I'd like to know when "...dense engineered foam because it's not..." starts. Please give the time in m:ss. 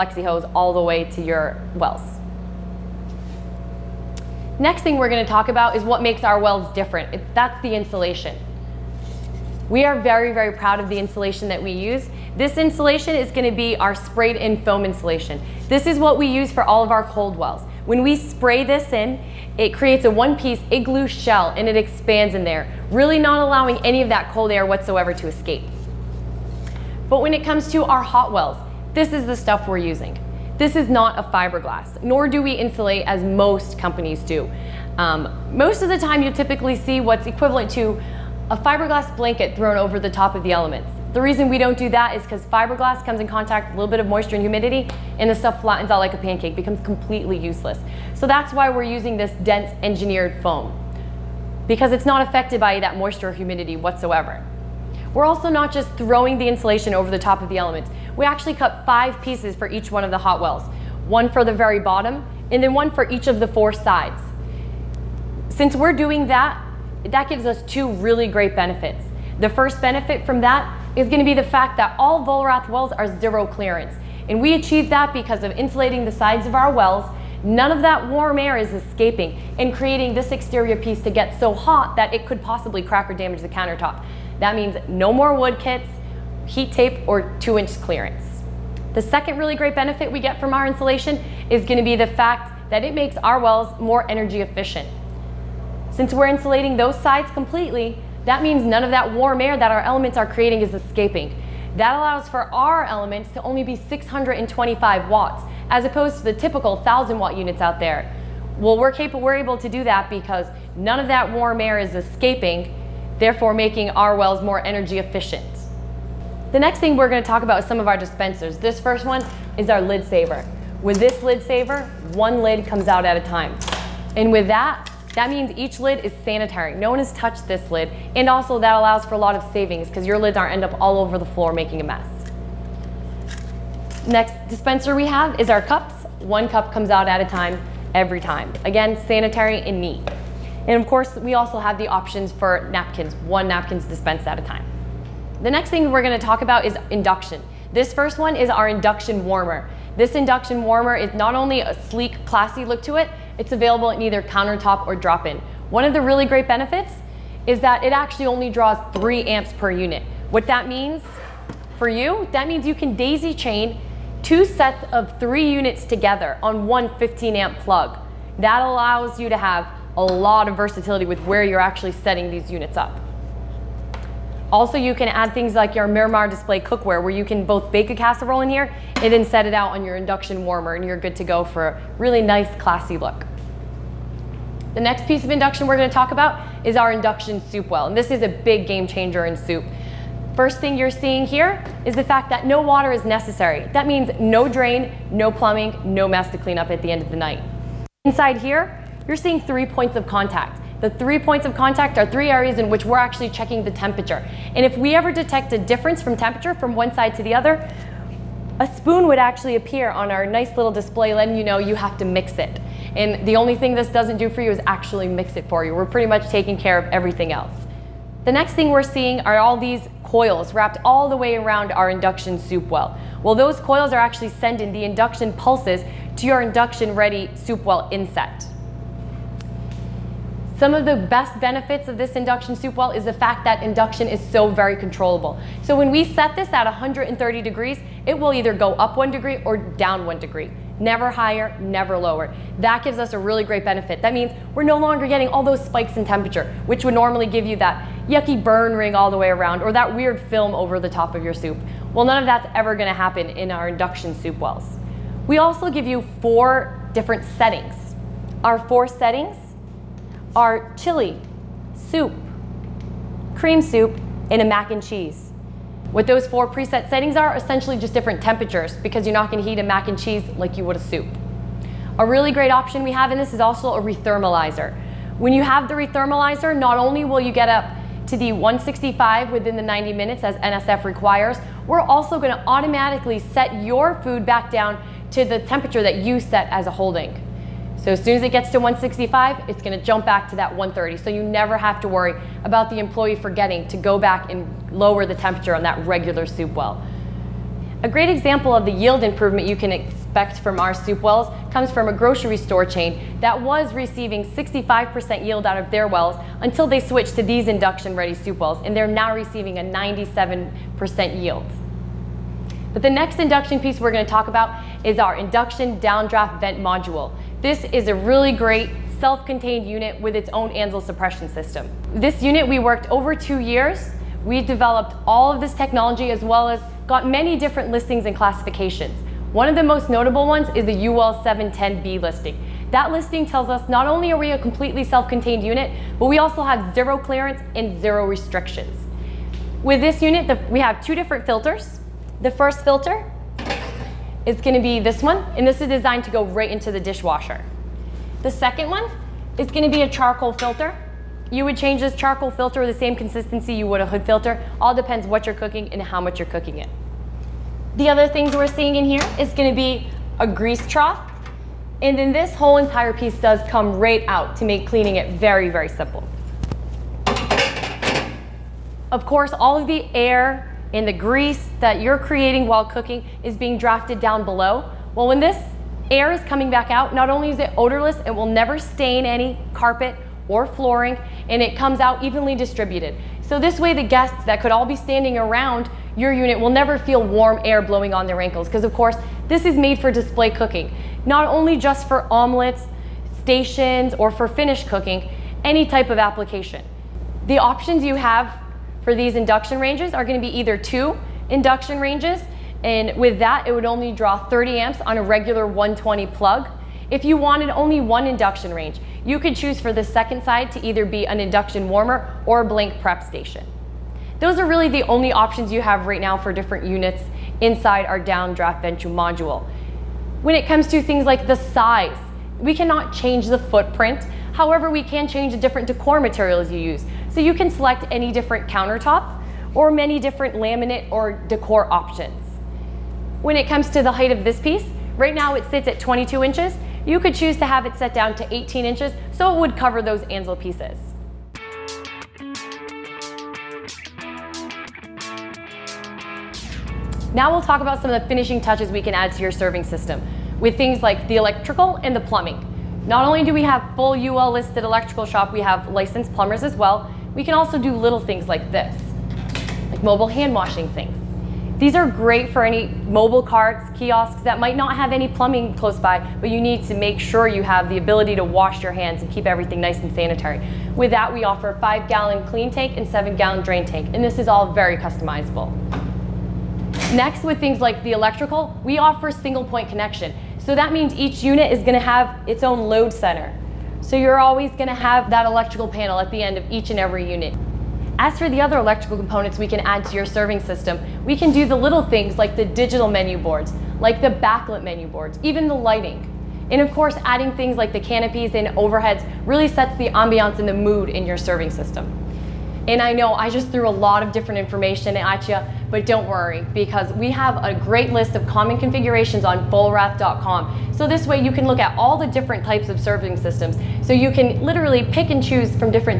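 0:49.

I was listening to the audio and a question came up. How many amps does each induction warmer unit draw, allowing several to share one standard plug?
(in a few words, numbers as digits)
3 amps.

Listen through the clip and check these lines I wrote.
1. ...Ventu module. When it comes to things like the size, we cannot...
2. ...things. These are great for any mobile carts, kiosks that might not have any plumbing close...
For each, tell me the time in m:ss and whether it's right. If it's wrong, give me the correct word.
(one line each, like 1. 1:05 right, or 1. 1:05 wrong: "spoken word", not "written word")
1. 6:58 right
2. 7:40 right.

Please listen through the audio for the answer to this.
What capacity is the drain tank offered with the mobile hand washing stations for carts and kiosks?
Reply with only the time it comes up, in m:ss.
7:52.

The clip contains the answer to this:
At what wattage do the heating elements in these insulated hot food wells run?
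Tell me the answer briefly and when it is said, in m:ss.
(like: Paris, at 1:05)
625 watts, at 1:43.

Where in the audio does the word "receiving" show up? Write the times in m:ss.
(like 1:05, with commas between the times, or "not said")
5:03, 5:09.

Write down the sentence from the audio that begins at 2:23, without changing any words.
One napkin's dispensed at a time.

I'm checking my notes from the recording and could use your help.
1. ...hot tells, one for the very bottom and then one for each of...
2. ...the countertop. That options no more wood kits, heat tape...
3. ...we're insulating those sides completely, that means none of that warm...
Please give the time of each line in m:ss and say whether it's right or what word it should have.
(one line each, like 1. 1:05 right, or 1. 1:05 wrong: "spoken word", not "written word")
1. 1:00 wrong: "wells", not "tells"
2. 1:23 wrong: "means", not "options"
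3. 1:36 right.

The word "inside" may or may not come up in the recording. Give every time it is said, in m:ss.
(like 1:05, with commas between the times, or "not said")
3:18, 6:57.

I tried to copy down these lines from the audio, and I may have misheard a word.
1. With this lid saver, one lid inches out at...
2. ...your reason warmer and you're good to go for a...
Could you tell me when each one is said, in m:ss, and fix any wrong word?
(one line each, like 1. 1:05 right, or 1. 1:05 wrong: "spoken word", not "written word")
1. 2:00 wrong: "comes", not "inches"
2. 2:59 wrong: "induction", not "reason".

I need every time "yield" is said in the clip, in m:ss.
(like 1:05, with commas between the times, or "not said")
4:58, 5:05, 5:11.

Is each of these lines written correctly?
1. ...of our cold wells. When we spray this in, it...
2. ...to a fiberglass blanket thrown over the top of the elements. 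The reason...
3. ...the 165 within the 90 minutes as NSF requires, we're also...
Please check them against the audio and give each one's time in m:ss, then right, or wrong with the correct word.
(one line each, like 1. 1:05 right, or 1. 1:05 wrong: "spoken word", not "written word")
1. 0:16 right
2. 0:37 right
3. 4:38 right.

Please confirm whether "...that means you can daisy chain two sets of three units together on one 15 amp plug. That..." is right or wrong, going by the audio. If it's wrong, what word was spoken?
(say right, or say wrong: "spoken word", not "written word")
right.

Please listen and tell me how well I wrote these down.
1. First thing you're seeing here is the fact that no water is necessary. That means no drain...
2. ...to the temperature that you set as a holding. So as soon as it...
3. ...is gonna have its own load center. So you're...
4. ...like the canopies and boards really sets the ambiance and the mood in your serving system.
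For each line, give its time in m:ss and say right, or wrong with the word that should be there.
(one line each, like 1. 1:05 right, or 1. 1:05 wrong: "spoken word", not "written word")
1. 3:10 right
2. 4:45 right
3. 8:01 right
4. 8:17 wrong: "overheads", not "boards".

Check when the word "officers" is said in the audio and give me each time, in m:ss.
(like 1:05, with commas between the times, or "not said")
not said.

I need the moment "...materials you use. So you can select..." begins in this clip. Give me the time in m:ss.
7:05.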